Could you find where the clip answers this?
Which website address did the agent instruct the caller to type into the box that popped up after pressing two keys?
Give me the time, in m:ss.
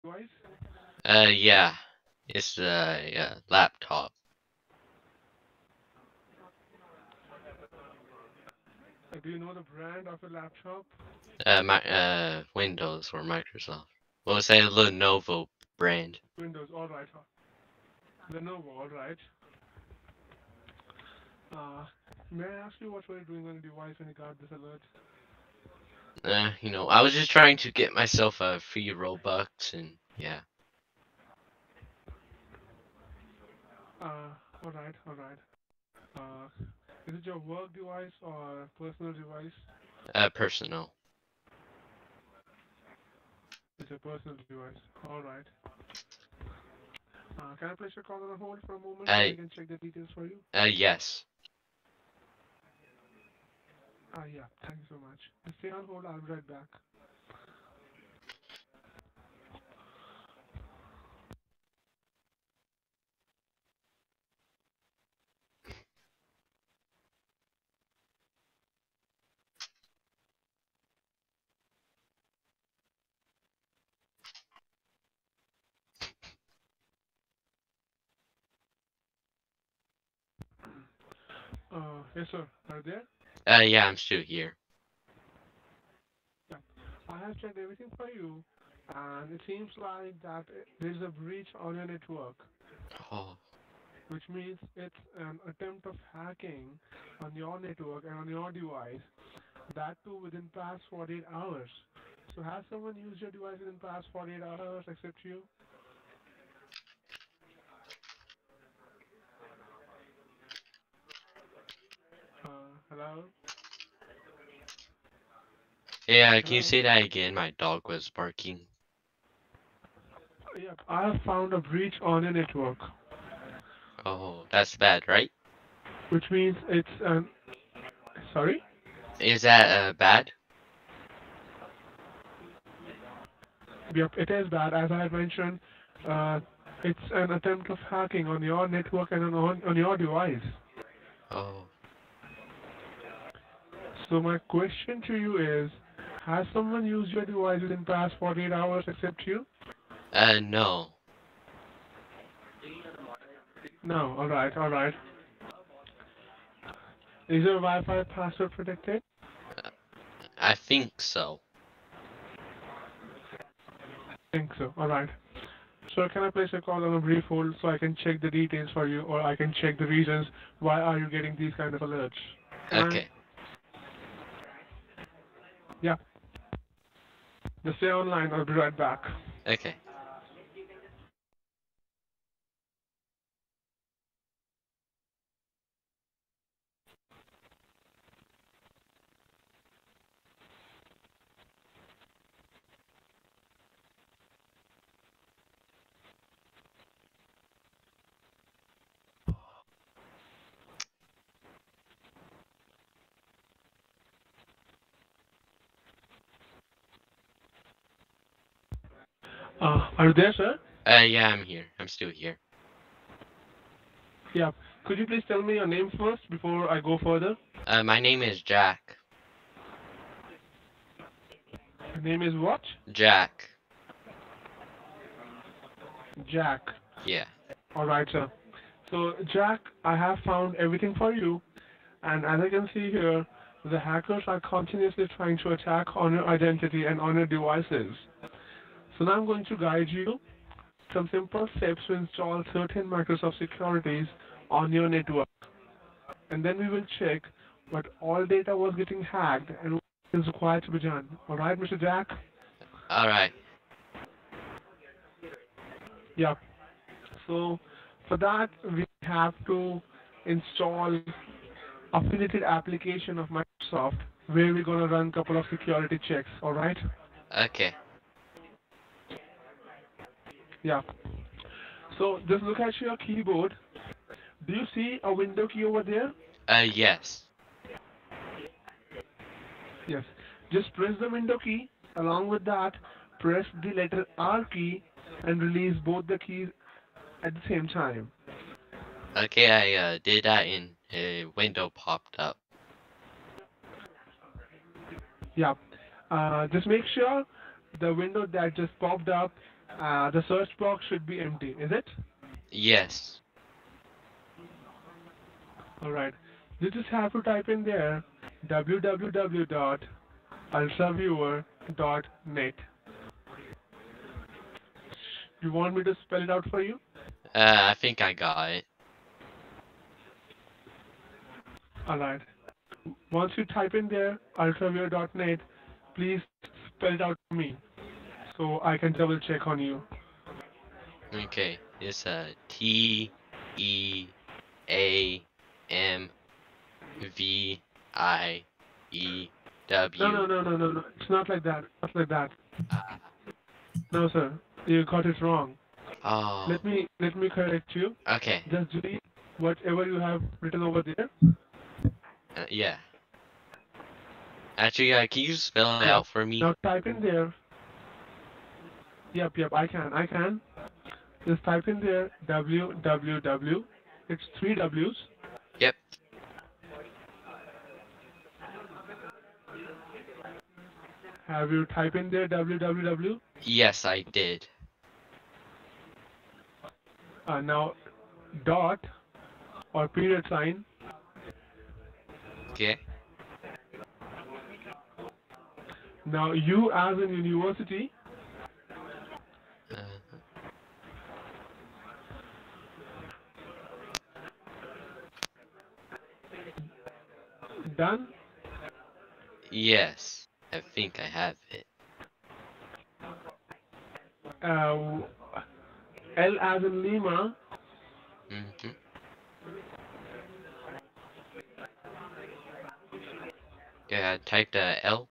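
5:08.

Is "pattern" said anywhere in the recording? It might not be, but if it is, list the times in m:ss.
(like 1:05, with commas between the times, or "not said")
not said.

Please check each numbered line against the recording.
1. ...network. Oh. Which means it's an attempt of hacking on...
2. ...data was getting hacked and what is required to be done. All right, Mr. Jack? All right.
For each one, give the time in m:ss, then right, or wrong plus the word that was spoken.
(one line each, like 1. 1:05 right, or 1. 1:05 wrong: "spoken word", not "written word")
1. 1:31 right
2. 4:08 right.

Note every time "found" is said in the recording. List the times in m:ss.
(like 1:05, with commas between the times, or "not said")
2:01, 3:50.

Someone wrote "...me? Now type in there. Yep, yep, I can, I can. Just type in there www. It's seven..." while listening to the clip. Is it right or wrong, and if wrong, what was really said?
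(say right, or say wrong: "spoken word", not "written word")
wrong: "three", not "seven".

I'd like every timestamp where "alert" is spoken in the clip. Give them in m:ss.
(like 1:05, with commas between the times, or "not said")
0:24, 2:51.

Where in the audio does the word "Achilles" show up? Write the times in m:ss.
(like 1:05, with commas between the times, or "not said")
not said.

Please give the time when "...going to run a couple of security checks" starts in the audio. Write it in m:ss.
4:24.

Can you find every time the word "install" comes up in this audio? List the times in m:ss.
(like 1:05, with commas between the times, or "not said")
4:01, 4:20.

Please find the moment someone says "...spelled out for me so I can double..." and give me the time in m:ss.
5:26.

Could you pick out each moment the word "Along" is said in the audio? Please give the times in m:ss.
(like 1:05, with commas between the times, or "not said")
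4:41.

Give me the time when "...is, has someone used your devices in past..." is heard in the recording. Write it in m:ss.
2:25.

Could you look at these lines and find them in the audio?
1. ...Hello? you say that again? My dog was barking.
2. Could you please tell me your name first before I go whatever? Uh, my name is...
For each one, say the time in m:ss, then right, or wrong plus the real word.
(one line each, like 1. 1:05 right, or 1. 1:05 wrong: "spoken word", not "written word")
1. 1:56 right
2. 3:34 wrong: "further", not "whatever".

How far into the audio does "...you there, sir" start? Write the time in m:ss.
3:30.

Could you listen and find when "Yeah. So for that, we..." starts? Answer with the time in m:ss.
4:16.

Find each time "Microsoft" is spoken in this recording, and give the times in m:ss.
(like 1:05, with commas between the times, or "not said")
0:13, 4:02, 4:23.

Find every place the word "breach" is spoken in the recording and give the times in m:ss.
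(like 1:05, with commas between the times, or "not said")
1:31, 2:01.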